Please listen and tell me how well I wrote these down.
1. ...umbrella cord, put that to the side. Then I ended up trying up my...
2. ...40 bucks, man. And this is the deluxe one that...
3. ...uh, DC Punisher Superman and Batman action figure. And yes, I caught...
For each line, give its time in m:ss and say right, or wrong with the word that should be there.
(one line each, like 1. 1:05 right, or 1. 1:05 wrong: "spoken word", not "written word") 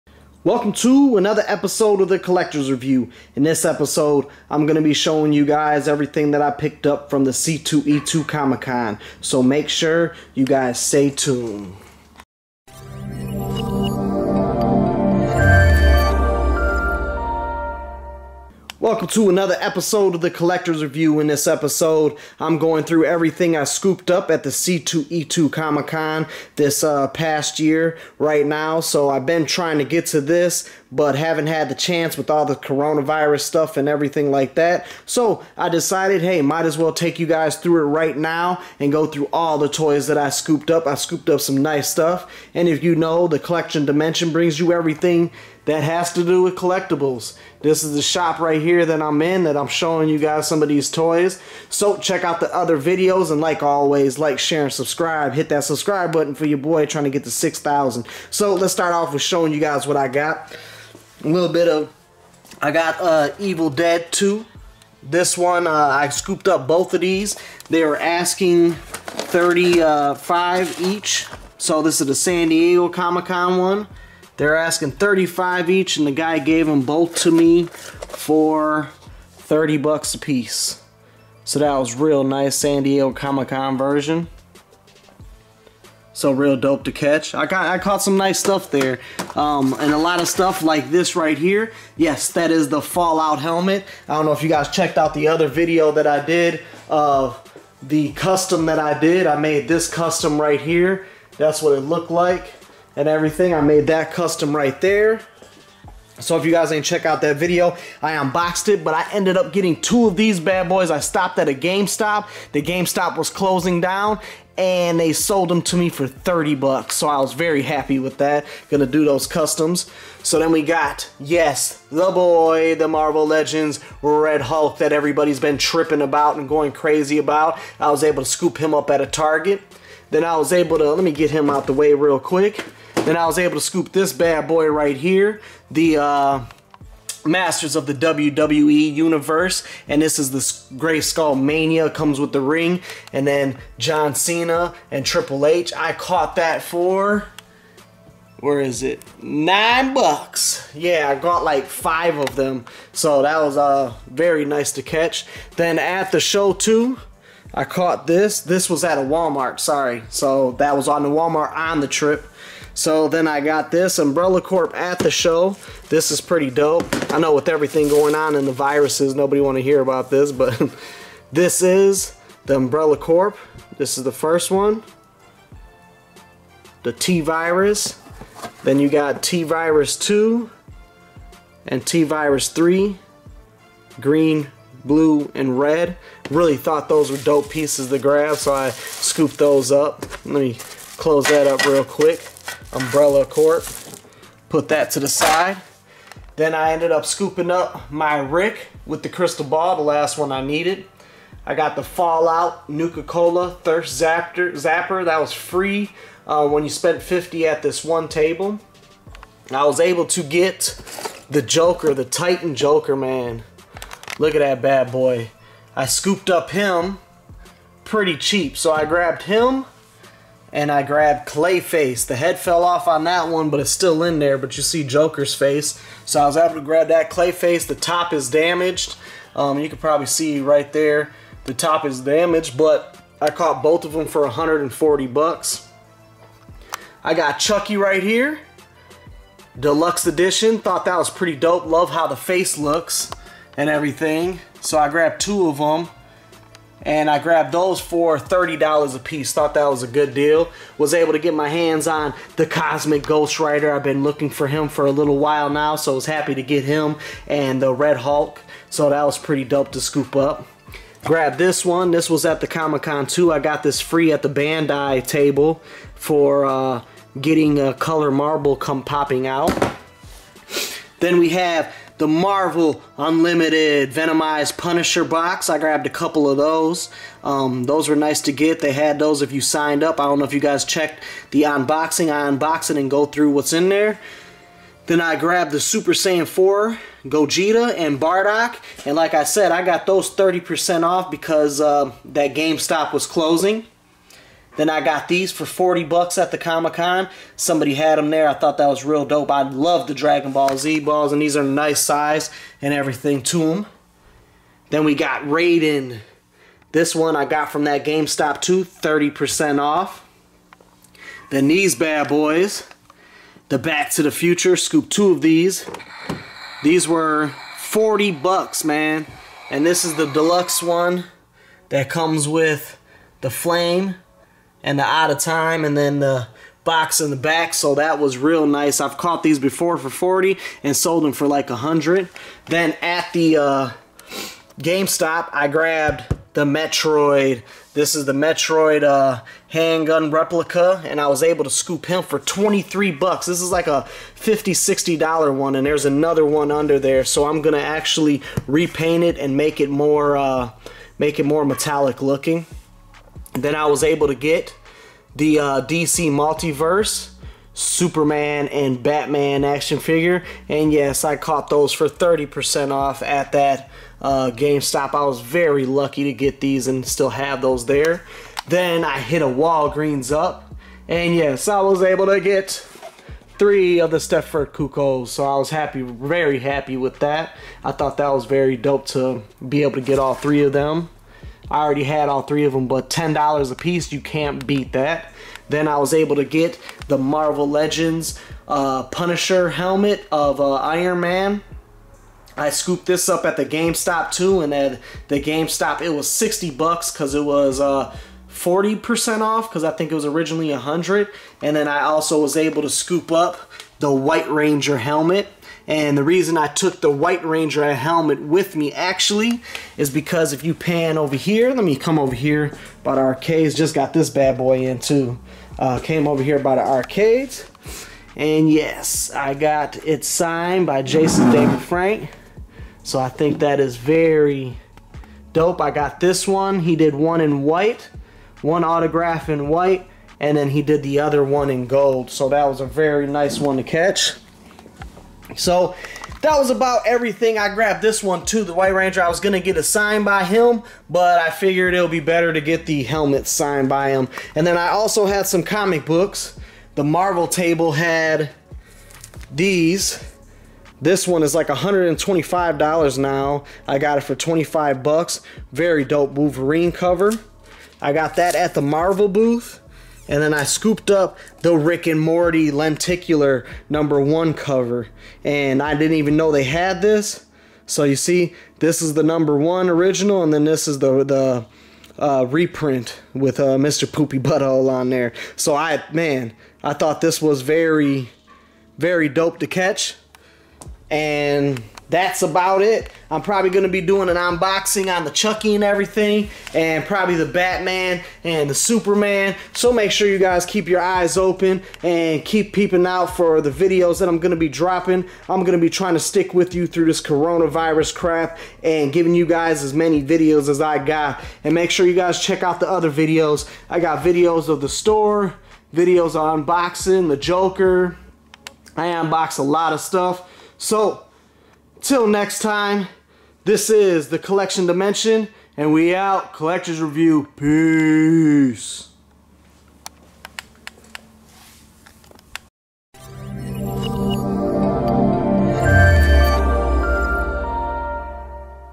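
1. 3:12 wrong: "scooping", not "trying"
2. 5:17 right
3. 5:55 wrong: "Multiverse", not "Punisher".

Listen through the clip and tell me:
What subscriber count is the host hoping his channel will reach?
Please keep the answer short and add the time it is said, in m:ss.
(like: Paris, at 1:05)
6,000, at 0:57.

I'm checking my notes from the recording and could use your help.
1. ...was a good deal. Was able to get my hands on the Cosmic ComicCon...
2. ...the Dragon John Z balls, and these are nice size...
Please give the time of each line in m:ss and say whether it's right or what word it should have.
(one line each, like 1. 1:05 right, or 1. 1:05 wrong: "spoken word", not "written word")
1. 4:09 wrong: "Ghost", not "ComicCon"
2. 4:59 wrong: "Ball", not "John".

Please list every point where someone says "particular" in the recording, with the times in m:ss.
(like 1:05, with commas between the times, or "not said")
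not said.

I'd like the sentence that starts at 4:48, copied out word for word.
And like I said, I got those 30% off because uh, that GameStop was closing.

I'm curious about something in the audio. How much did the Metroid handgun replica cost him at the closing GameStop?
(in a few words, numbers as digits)
$23.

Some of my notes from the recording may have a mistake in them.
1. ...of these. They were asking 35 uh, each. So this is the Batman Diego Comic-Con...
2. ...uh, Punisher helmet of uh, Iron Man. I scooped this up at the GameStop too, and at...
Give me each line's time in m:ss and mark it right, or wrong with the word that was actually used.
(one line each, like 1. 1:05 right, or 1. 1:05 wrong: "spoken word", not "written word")
1. 1:06 wrong: "San", not "Batman"
2. 6:28 right.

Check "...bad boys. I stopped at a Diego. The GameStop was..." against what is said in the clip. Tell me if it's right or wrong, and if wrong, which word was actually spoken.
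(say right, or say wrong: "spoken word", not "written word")
wrong: "GameStop", not "Diego".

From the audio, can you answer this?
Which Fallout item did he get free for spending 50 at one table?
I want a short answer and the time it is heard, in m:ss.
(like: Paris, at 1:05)
Nuka-Cola Thirst Zapper, at 3:22.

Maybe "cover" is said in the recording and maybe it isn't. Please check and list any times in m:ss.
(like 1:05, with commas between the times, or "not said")
7:36, 7:44.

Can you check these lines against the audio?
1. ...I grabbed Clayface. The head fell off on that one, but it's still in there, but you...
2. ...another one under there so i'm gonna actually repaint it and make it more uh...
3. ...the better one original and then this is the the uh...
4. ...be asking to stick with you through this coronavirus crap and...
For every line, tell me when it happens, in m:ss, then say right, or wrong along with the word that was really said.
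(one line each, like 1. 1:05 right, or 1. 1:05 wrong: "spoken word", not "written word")
1. 3:40 right
2. 5:45 right
3. 7:48 wrong: "number", not "better"
4. 8:15 wrong: "trying", not "asking".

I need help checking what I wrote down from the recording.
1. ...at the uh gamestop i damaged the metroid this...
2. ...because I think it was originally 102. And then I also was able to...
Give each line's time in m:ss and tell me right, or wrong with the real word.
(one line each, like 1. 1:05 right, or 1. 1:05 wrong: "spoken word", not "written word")
1. 5:32 wrong: "grabbed", not "damaged"
2. 6:39 wrong: "100", not "102".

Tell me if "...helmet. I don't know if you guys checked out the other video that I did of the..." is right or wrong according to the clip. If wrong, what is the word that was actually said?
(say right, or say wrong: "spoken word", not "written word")
right.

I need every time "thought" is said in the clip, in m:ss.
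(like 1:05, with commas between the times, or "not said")
3:06, 4:00, 4:09, 4:58, 6:17, 7:56.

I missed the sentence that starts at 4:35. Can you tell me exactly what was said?
I grabbed a couple of those.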